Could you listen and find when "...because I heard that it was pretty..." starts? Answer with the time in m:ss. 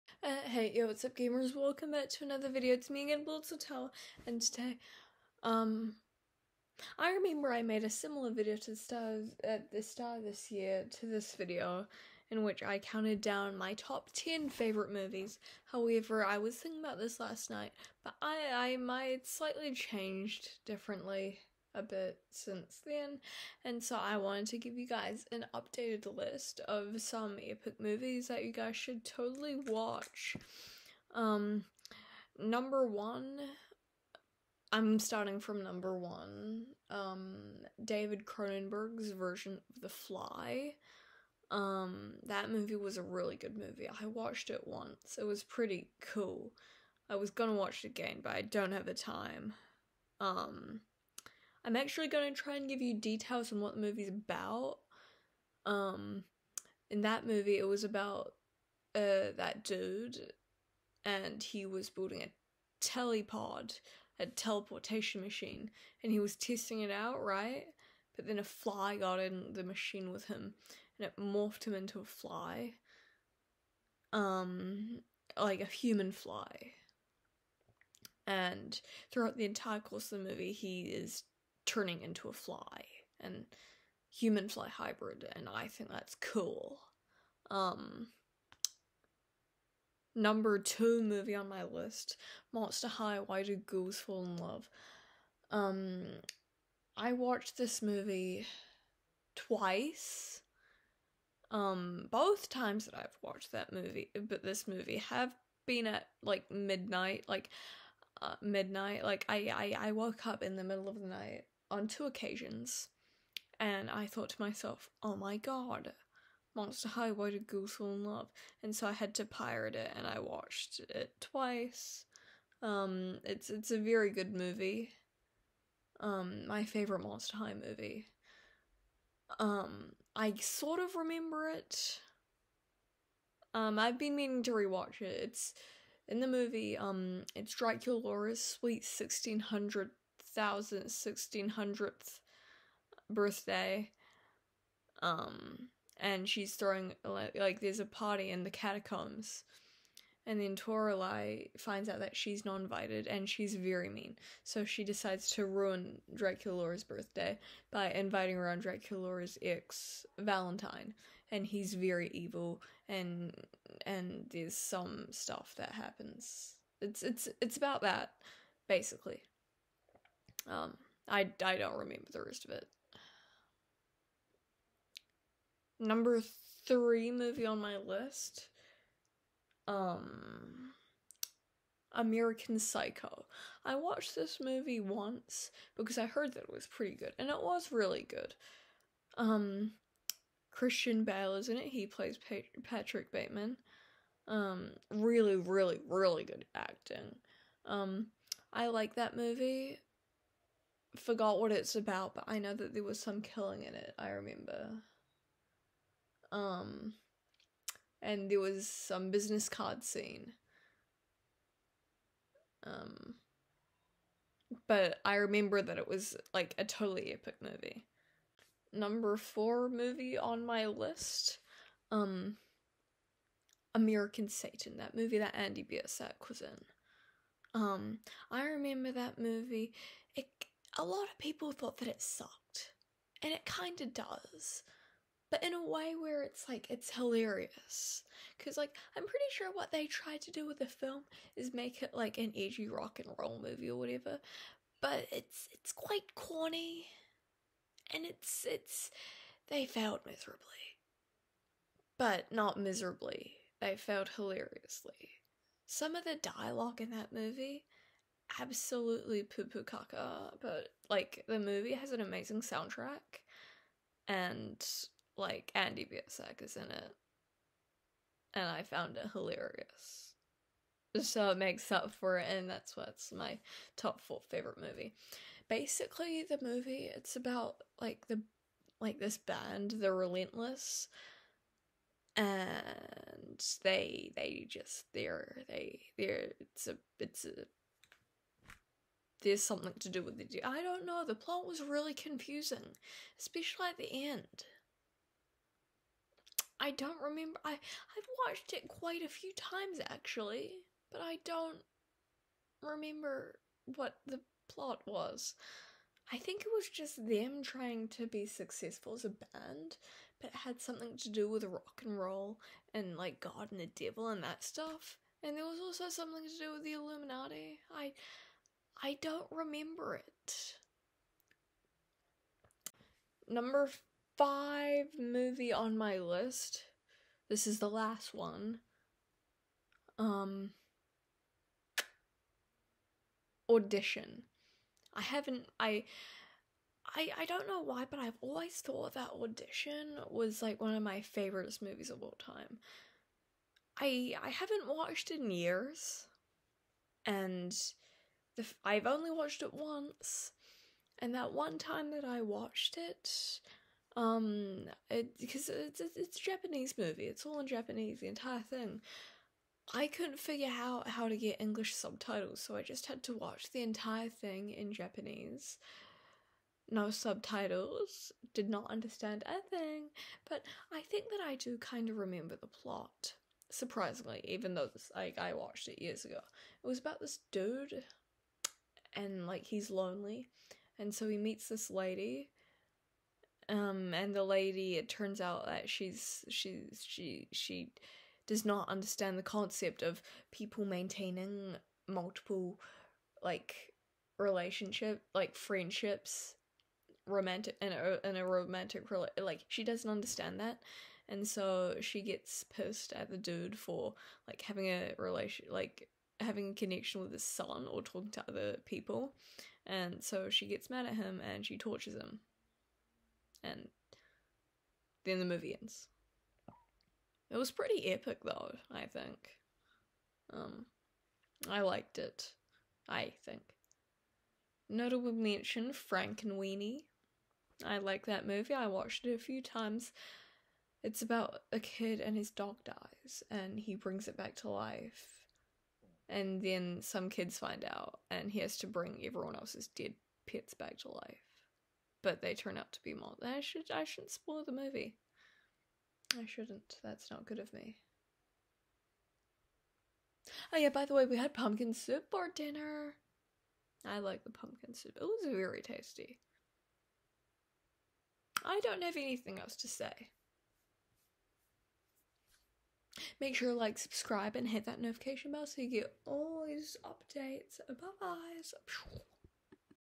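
3:05.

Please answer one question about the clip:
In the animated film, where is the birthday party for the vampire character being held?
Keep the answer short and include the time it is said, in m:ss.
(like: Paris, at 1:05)
The catacombs, at 2:28.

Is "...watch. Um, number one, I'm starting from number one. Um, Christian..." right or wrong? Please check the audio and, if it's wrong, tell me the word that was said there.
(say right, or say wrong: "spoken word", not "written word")
wrong: "David", not "Christian".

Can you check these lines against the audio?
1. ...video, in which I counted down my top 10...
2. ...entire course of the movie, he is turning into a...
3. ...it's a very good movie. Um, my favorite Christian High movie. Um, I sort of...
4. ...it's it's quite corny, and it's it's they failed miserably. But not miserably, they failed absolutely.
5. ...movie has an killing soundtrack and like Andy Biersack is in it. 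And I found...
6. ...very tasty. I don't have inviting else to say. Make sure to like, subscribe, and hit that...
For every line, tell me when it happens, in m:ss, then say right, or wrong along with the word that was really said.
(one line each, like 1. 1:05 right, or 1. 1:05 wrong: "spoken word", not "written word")
1. 0:11 right
2. 1:19 right
3. 2:03 wrong: "Monster", not "Christian"
4. 4:05 wrong: "hilariously", not "absolutely"
5. 4:21 wrong: "amazing", not "killing"
6. 7:35 wrong: "anything", not "inviting".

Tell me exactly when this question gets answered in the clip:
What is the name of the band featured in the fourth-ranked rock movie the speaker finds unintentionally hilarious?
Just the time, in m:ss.
4:39.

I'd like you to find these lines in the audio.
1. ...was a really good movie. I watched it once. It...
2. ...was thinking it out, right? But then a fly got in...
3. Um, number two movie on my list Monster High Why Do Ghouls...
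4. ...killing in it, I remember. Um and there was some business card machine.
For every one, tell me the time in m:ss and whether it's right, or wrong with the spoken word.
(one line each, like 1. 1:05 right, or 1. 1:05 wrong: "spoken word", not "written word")
1. 0:42 right
2. 1:06 wrong: "testing", not "thinking"
3. 1:27 right
4. 3:23 wrong: "scene", not "machine".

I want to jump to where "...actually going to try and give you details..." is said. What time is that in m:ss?
0:51.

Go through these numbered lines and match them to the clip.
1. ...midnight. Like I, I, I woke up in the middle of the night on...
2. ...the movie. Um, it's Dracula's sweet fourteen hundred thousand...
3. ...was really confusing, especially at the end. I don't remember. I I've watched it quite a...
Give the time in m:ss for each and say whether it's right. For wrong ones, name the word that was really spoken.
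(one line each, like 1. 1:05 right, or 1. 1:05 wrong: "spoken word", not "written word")
1. 1:48 right
2. 2:16 wrong: "sixteen", not "fourteen"
3. 4:51 right.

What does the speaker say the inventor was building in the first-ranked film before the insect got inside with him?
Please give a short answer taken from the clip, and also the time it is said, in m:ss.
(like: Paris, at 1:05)
A telepod, at 1:02.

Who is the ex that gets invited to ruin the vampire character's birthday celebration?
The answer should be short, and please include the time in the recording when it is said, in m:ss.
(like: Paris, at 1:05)
Valentine, at 2:40.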